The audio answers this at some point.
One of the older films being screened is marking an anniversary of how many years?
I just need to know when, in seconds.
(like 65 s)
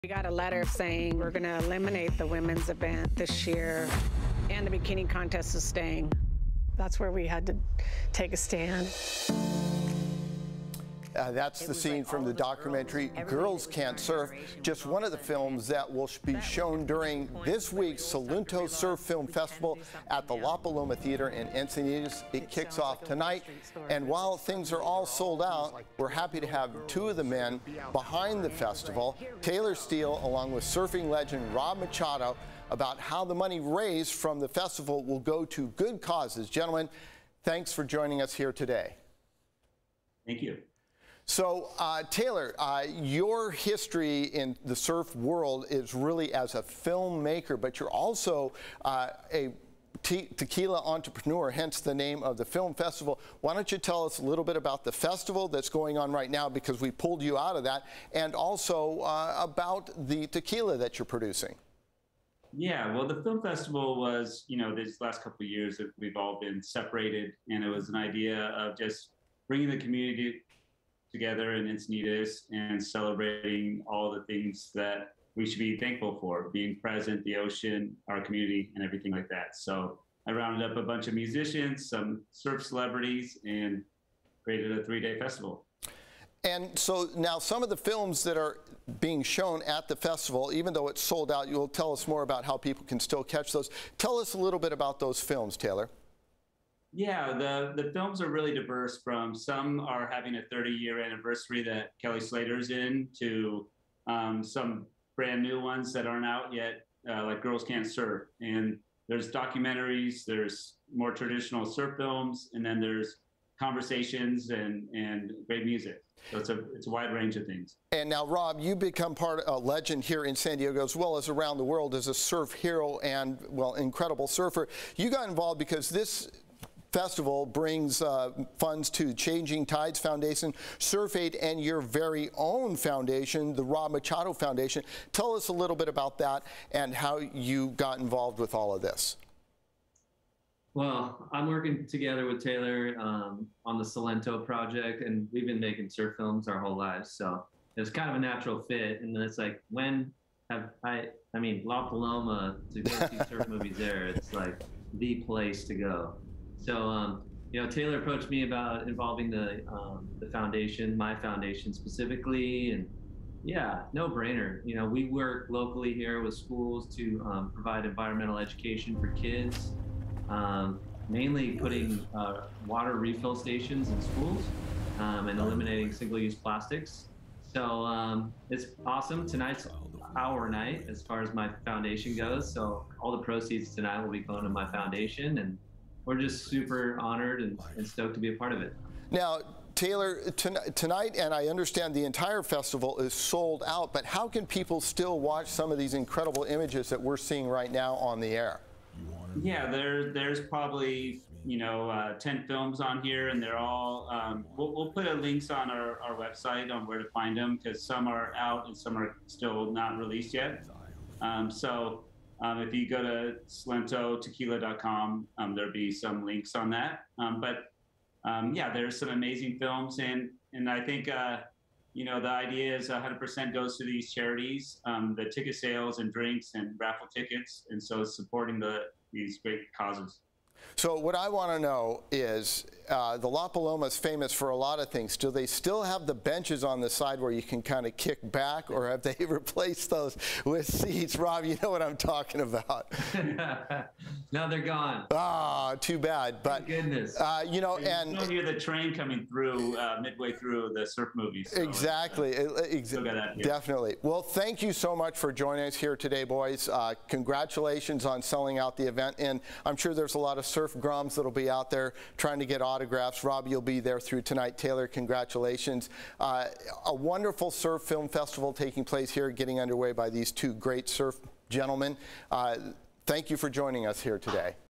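100 s.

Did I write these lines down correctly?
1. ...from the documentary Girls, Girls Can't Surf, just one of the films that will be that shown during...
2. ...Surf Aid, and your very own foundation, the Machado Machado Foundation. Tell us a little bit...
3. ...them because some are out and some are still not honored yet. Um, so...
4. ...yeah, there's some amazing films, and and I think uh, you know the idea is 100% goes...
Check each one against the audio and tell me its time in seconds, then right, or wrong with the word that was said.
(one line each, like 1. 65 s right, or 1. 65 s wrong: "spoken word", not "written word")
1. 12 s right
2. 130 s wrong: "Rob", not "Machado"
3. 207 s wrong: "released", not "honored"
4. 218 s right.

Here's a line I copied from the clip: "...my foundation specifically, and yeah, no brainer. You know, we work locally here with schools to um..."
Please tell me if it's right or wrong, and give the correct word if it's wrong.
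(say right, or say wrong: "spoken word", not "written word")
right.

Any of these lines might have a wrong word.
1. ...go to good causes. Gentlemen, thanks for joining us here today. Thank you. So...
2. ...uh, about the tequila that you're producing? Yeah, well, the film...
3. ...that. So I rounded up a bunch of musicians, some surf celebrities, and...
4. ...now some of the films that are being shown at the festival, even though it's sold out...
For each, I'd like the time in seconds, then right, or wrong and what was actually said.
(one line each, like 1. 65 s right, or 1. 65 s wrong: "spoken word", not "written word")
1. 35 s right
2. 59 s right
3. 79 s right
4. 87 s right.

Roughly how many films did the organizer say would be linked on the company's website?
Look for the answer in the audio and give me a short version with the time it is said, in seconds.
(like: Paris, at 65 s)
10, at 202 s.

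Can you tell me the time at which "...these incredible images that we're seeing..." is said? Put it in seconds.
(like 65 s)
195 s.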